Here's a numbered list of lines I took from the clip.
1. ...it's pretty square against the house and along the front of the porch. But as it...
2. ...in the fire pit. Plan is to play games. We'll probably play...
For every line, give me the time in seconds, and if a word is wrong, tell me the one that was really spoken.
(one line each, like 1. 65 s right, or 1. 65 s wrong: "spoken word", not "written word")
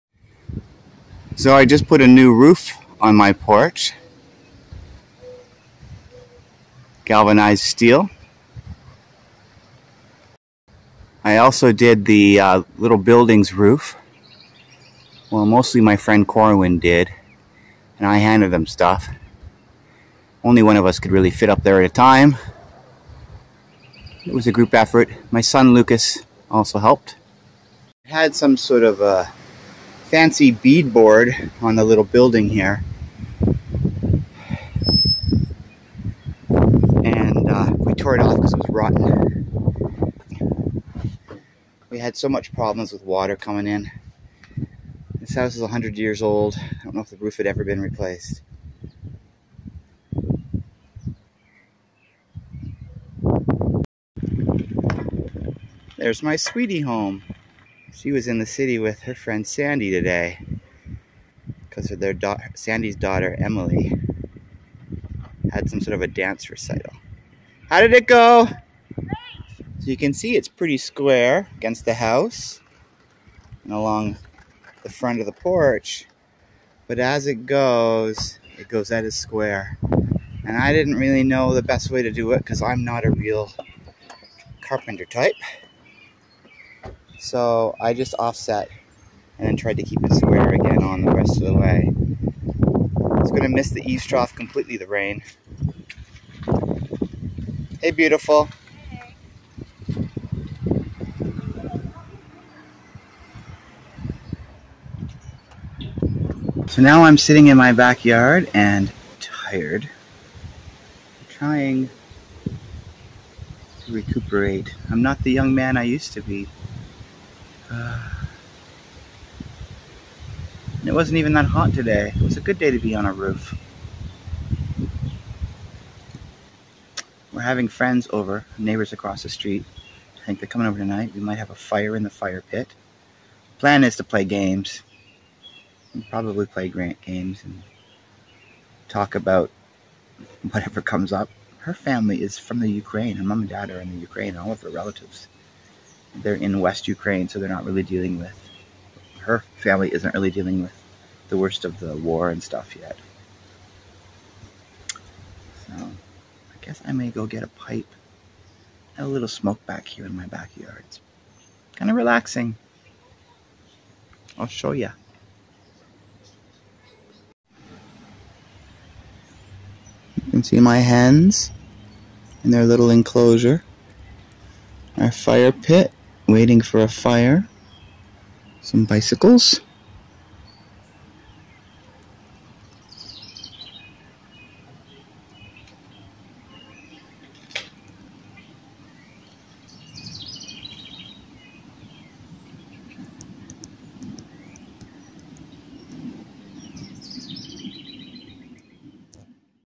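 1. 70 s right
2. 131 s right.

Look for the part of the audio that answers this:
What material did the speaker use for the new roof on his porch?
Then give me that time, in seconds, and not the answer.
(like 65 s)
7 s.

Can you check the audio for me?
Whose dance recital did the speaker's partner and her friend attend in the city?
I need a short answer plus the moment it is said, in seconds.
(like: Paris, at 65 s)
Emily, at 63 s.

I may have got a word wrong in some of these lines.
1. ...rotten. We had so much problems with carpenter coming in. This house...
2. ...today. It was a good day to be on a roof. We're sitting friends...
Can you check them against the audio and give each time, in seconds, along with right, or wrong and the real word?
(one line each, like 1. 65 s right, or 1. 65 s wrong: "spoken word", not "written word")
1. 38 s wrong: "water", not "carpenter"
2. 121 s wrong: "having", not "sitting".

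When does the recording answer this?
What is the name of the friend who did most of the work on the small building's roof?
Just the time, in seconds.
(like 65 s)
16 s.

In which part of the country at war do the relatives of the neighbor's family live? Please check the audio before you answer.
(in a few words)
West Ukraine.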